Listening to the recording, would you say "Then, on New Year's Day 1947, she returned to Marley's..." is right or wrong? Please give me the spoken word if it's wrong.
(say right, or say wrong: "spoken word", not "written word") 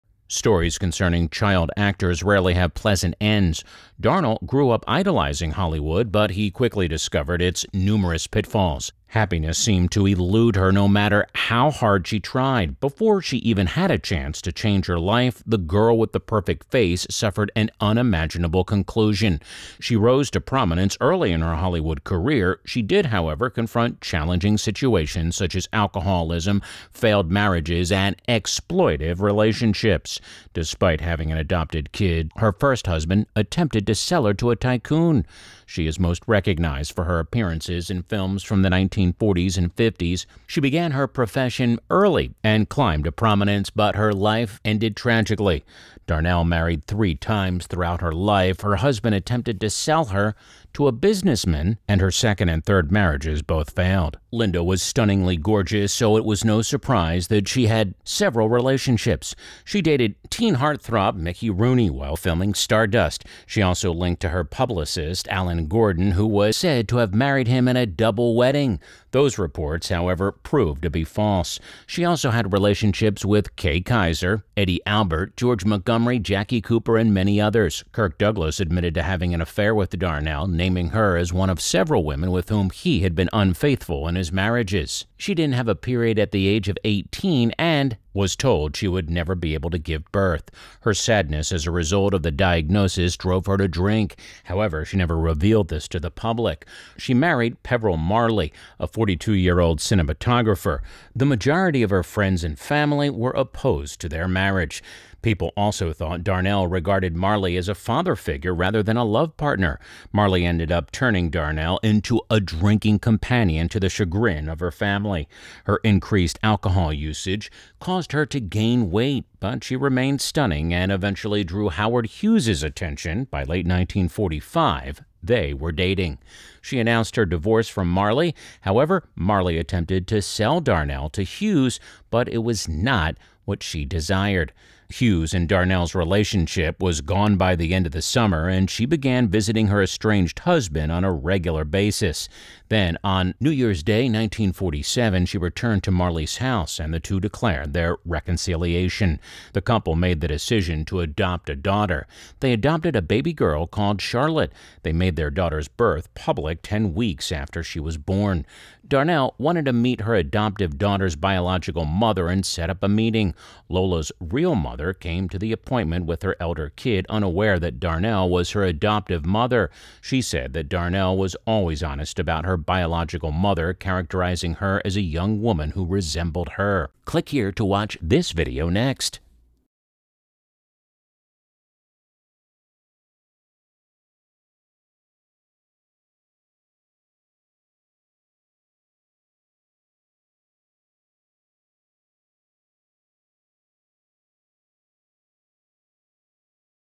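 right.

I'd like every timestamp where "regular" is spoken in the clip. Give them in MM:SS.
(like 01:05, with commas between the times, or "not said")
02:21.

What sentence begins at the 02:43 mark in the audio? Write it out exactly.
Lola's real mother mother came to the appointment with her elder kid unaware that Darnell was her adoptive mother.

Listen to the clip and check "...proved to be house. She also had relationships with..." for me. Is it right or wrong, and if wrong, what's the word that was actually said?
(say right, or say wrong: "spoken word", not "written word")
wrong: "false", not "house".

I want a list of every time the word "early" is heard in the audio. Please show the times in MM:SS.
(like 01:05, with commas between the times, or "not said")
00:21, 00:41.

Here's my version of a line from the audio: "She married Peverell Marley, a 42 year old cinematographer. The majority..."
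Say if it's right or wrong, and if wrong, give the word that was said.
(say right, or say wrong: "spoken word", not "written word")
right.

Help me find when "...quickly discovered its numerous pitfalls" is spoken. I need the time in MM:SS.
00:06.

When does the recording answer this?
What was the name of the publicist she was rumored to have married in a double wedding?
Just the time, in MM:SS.
01:05.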